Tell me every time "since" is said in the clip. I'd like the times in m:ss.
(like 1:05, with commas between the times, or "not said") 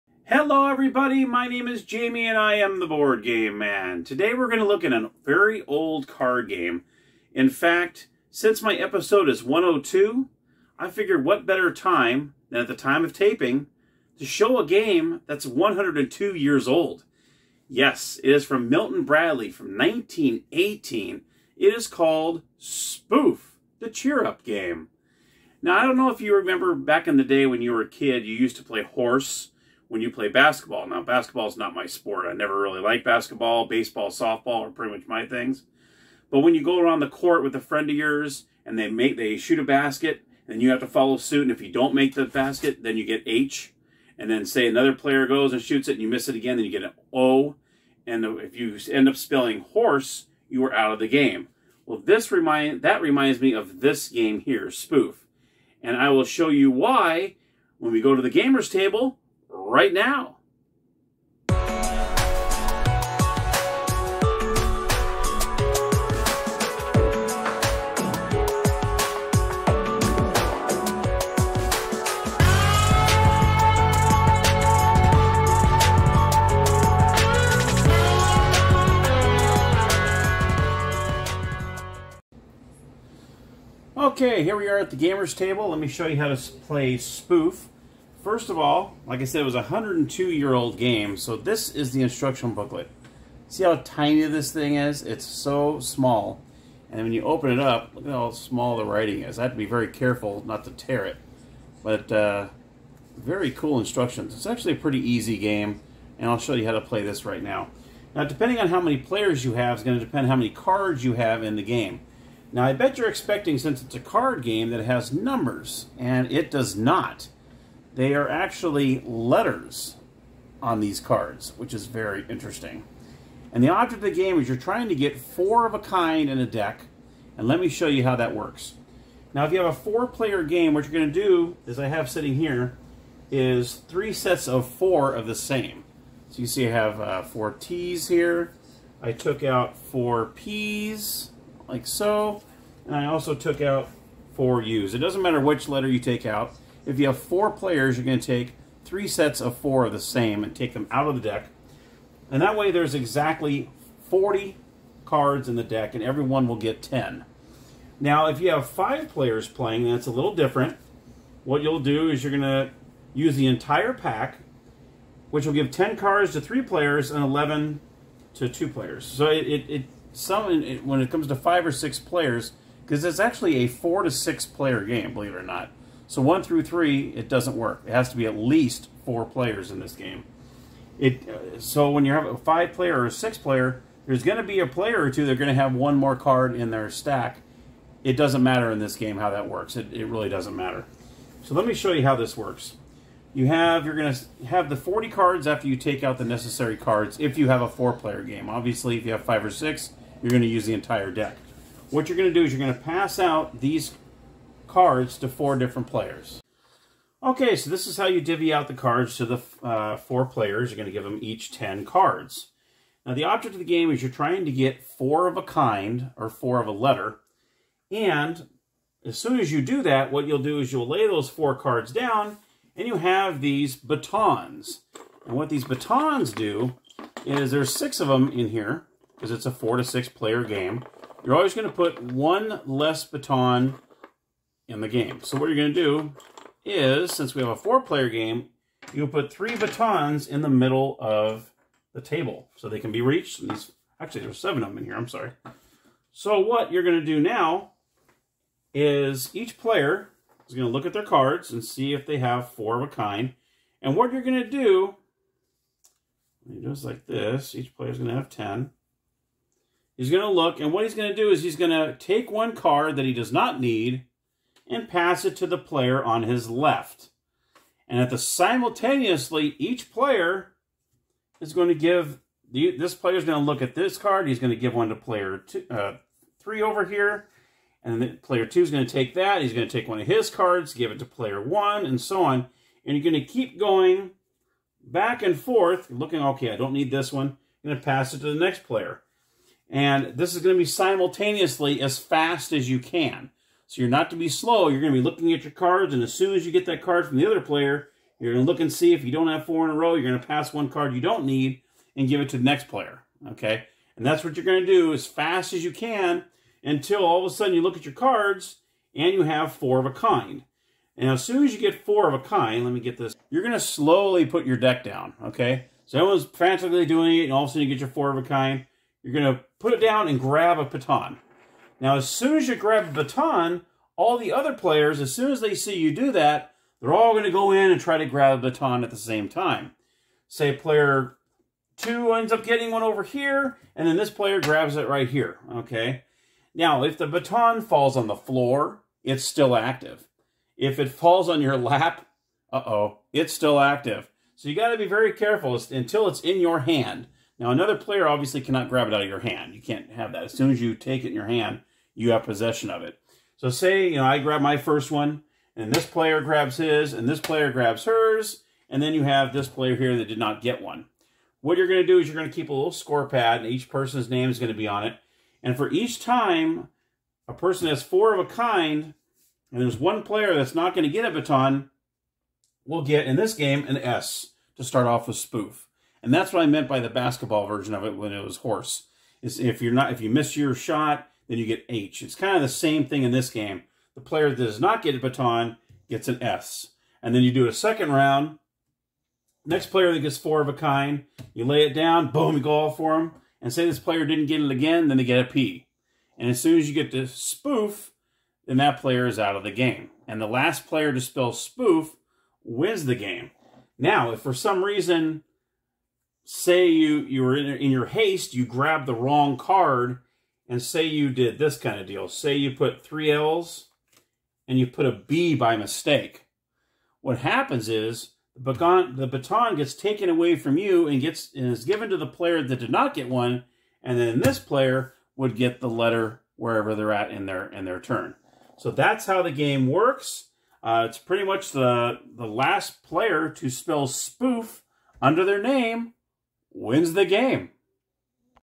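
0:08, 1:53, 3:57.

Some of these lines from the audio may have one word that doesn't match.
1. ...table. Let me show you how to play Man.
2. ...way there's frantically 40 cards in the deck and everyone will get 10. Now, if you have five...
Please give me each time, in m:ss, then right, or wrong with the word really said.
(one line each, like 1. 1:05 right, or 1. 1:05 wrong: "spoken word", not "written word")
1. 1:25 wrong: "Spoof", not "Man"
2. 2:32 wrong: "exactly", not "frantically".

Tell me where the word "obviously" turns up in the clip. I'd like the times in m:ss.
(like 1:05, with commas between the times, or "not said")
3:18, 5:48.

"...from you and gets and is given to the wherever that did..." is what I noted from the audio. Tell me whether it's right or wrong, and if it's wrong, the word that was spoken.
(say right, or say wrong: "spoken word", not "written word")
wrong: "player", not "wherever".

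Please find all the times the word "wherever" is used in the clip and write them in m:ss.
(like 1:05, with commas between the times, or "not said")
7:06.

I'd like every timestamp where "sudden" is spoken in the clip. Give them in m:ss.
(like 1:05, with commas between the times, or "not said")
5:07, 5:17.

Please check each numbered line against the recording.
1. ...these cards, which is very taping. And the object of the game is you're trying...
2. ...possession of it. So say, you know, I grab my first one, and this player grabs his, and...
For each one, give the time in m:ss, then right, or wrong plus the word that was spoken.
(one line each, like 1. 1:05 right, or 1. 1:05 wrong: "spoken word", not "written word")
1. 2:00 wrong: "interesting", not "taping"
2. 5:52 right.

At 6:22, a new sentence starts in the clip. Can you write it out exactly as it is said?
It's kind of the same thing in this game.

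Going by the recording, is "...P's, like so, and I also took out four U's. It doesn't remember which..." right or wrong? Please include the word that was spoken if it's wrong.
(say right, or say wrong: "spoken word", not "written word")
wrong: "matter", not "remember".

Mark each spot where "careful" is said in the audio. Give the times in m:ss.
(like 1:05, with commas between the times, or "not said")
1:39, 5:45.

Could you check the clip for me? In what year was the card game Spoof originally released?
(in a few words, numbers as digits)
1918.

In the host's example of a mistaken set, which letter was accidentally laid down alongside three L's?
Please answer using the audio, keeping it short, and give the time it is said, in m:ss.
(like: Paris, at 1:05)
B, at 6:54.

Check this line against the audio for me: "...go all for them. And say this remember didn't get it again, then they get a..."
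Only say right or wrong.
wrong.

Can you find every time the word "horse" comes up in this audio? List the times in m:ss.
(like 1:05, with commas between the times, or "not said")
0:28, 0:49, 6:18.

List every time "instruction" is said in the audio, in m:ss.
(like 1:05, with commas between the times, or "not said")
1:32, 1:43.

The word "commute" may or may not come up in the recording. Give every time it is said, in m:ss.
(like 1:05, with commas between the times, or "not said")
not said.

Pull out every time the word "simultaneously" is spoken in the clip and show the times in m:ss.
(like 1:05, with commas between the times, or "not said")
4:28, 4:50.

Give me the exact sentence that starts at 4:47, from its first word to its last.
I'm going to pass it to the next player.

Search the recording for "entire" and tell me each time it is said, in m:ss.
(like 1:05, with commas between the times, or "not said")
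2:43, 3:20.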